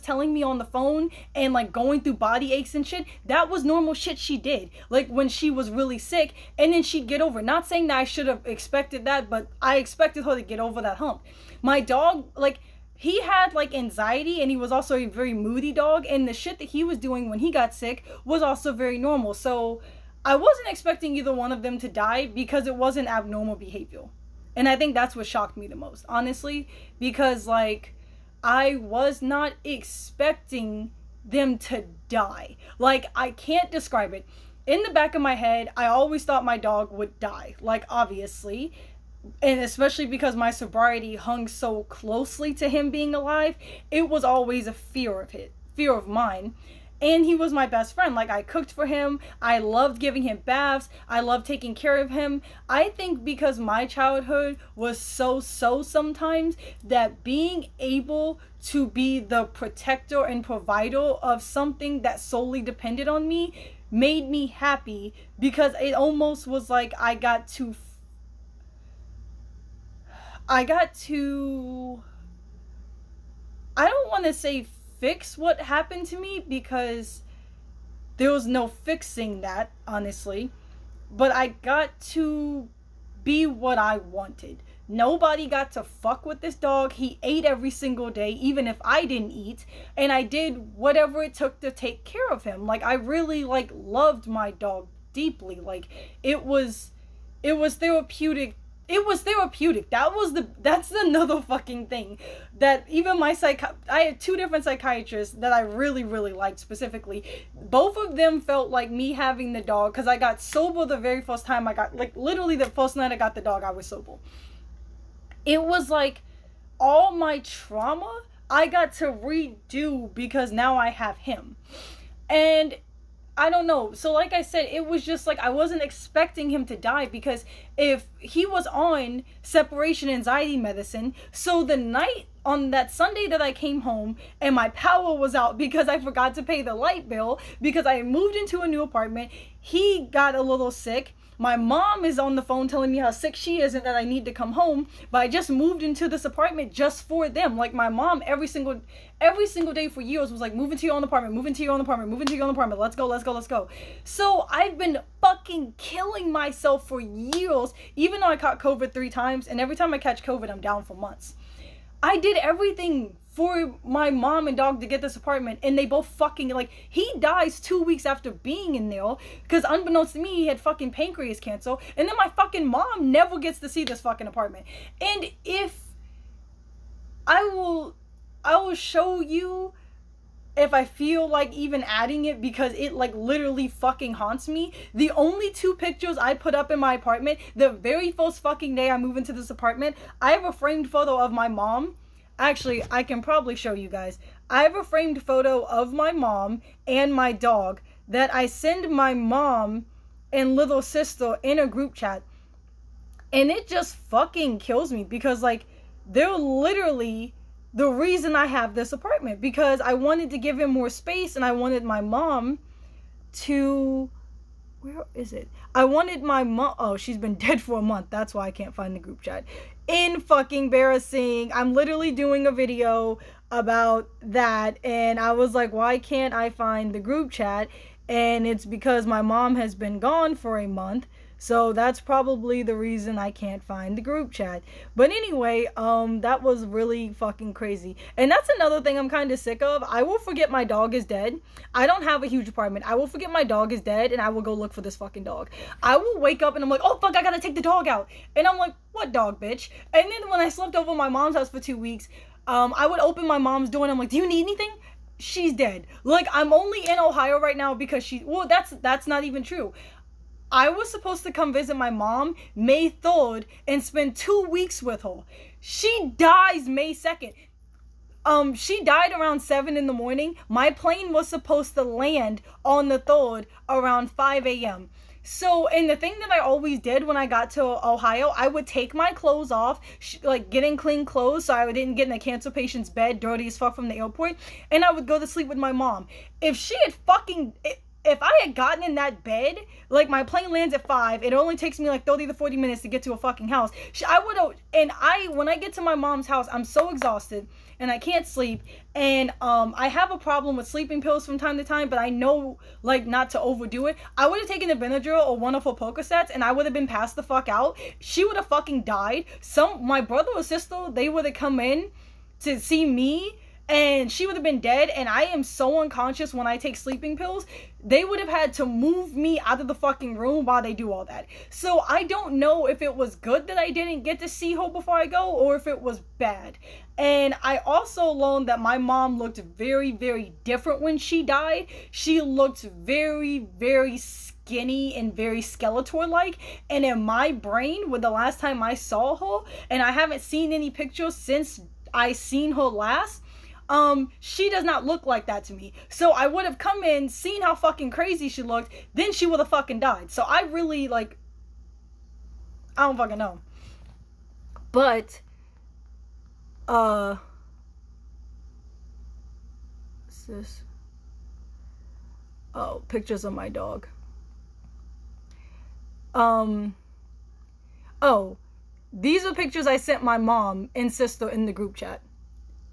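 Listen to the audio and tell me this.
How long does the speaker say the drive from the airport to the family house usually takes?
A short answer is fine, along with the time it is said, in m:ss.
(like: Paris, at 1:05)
30 to 40 minutes, at 4:52.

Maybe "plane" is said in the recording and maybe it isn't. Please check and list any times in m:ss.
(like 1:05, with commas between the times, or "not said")
4:30, 4:50.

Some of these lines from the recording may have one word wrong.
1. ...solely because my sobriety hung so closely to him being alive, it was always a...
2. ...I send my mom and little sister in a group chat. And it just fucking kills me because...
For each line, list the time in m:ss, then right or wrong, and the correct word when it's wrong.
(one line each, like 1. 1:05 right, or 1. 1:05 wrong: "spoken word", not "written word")
1. 0:39 wrong: "especially", not "solely"
2. 3:18 right.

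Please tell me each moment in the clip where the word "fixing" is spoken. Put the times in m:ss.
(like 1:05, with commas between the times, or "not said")
1:18.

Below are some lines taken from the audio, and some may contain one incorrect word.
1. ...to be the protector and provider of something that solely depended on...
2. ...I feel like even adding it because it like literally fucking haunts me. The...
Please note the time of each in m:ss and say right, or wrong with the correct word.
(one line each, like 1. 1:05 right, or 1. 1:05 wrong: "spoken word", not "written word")
1. 0:58 right
2. 3:00 right.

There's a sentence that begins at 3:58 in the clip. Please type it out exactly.
And that's another thing I'm kind of sick of.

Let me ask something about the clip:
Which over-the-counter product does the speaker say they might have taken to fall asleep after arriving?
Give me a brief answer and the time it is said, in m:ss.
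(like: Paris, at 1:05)
Benadryl, at 5:04.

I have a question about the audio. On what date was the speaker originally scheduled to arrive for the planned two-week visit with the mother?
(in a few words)
May 3rd.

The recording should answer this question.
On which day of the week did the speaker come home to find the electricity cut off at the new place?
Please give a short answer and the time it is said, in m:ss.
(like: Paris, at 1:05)
Sunday, at 2:12.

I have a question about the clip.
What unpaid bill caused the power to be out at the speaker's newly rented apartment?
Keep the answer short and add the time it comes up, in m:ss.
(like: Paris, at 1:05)
light bill, at 2:16.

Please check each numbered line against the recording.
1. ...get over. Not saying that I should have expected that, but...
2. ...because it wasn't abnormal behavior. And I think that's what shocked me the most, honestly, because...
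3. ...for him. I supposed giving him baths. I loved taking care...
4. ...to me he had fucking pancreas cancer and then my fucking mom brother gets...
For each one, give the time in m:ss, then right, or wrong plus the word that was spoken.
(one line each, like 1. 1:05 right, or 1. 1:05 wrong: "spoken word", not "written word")
1. 0:07 right
2. 0:22 right
3. 0:48 wrong: "loved", not "supposed"
4. 2:50 wrong: "never", not "brother".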